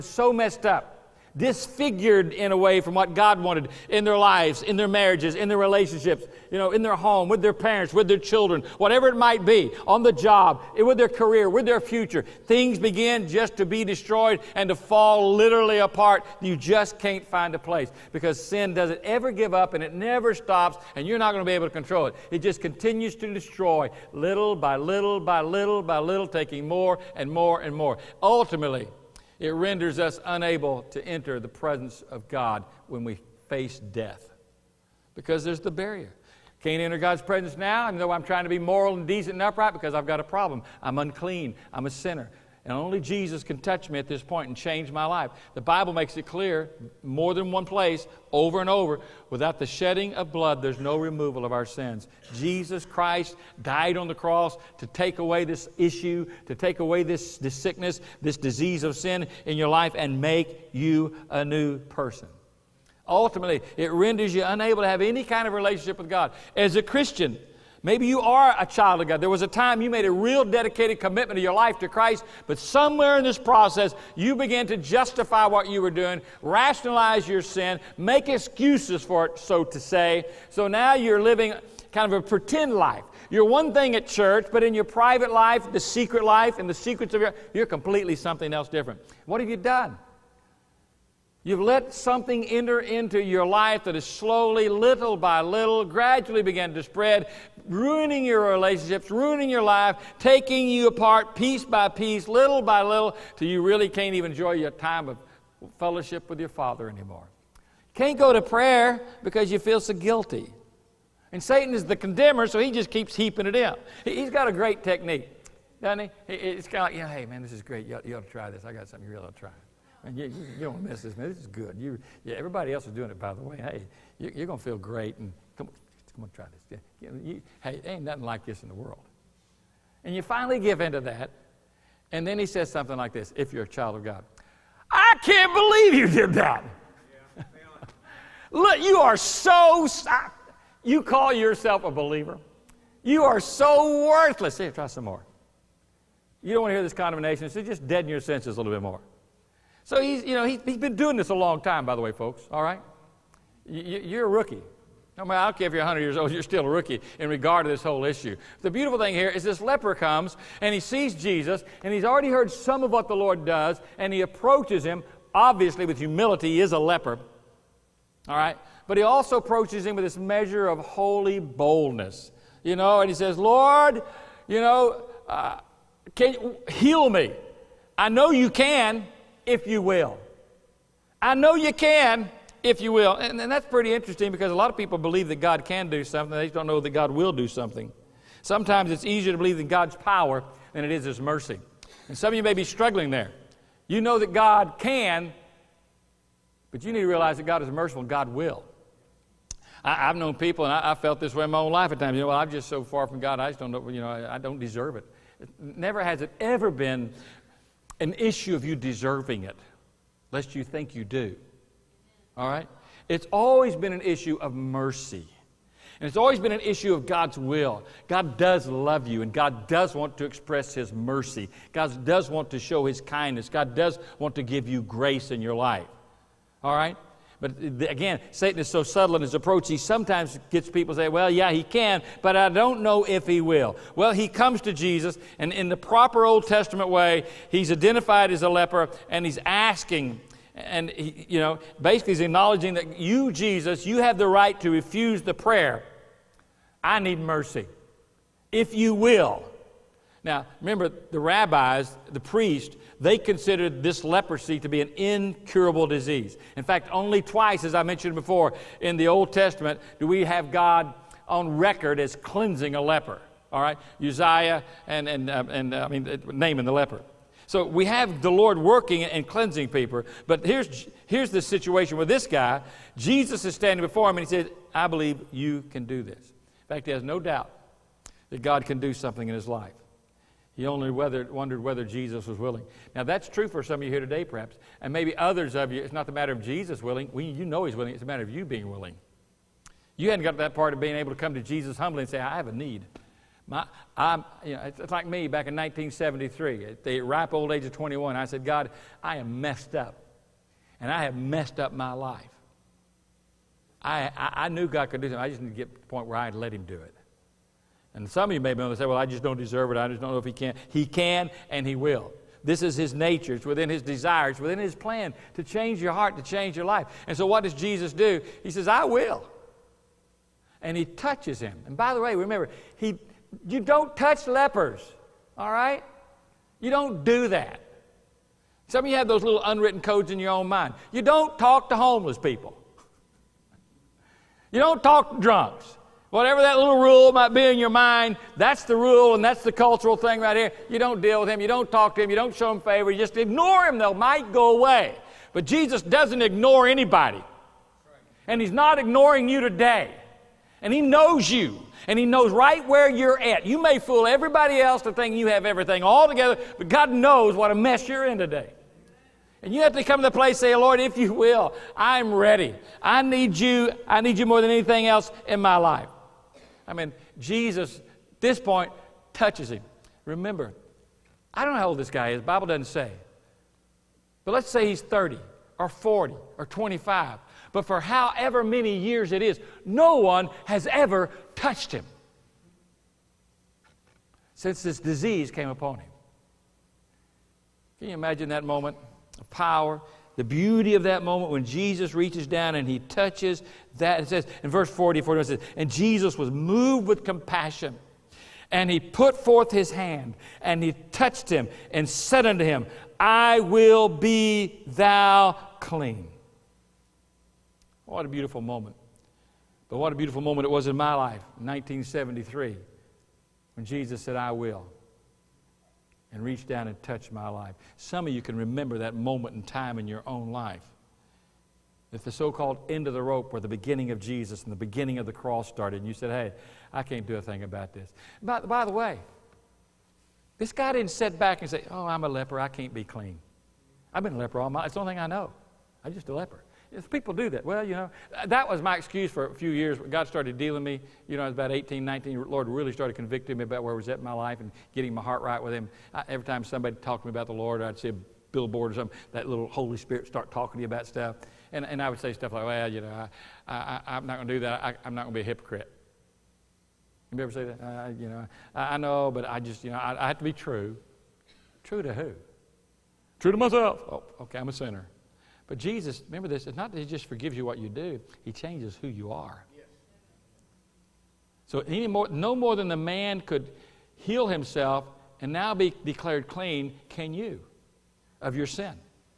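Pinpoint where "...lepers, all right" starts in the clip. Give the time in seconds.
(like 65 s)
324 s.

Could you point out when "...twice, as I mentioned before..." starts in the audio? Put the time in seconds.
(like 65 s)
257 s.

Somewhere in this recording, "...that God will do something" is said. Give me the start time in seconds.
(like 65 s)
186 s.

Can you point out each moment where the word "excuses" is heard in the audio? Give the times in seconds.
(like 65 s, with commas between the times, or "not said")
78 s, 438 s.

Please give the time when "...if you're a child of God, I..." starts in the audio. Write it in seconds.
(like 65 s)
133 s.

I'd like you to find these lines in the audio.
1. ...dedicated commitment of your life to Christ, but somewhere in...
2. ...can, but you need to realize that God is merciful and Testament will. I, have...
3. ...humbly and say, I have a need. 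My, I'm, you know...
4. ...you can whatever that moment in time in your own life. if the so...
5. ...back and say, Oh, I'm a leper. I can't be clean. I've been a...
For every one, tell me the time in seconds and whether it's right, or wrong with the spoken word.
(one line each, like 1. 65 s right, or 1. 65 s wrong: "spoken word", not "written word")
1. 70 s right
2. 194 s wrong: "God", not "Testament"
3. 291 s right
4. 418 s wrong: "remember", not "whatever"
5. 431 s right.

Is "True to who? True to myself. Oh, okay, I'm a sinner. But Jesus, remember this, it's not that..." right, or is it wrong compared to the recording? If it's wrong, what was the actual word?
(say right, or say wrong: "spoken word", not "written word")
right.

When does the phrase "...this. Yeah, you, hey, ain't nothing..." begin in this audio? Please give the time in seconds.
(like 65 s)
126 s.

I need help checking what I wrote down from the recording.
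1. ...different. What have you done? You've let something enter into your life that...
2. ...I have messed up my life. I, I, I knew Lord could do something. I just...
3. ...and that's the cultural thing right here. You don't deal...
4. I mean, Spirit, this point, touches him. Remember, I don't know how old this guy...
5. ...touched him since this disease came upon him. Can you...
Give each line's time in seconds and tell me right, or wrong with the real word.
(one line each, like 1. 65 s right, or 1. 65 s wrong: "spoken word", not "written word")
1. 88 s right
2. 300 s wrong: "God", not "Lord"
3. 339 s right
4. 366 s wrong: "Jesus", not "Spirit"
5. 381 s right.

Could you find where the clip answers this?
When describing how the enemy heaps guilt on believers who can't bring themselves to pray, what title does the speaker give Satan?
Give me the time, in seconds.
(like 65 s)
111 s.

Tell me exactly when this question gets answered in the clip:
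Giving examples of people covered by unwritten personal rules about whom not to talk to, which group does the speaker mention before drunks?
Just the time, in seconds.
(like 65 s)
331 s.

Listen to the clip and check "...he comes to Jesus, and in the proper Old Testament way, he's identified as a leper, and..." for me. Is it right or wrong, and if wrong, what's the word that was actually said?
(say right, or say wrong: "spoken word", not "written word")
right.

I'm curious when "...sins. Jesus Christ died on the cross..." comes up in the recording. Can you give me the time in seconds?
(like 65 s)
51 s.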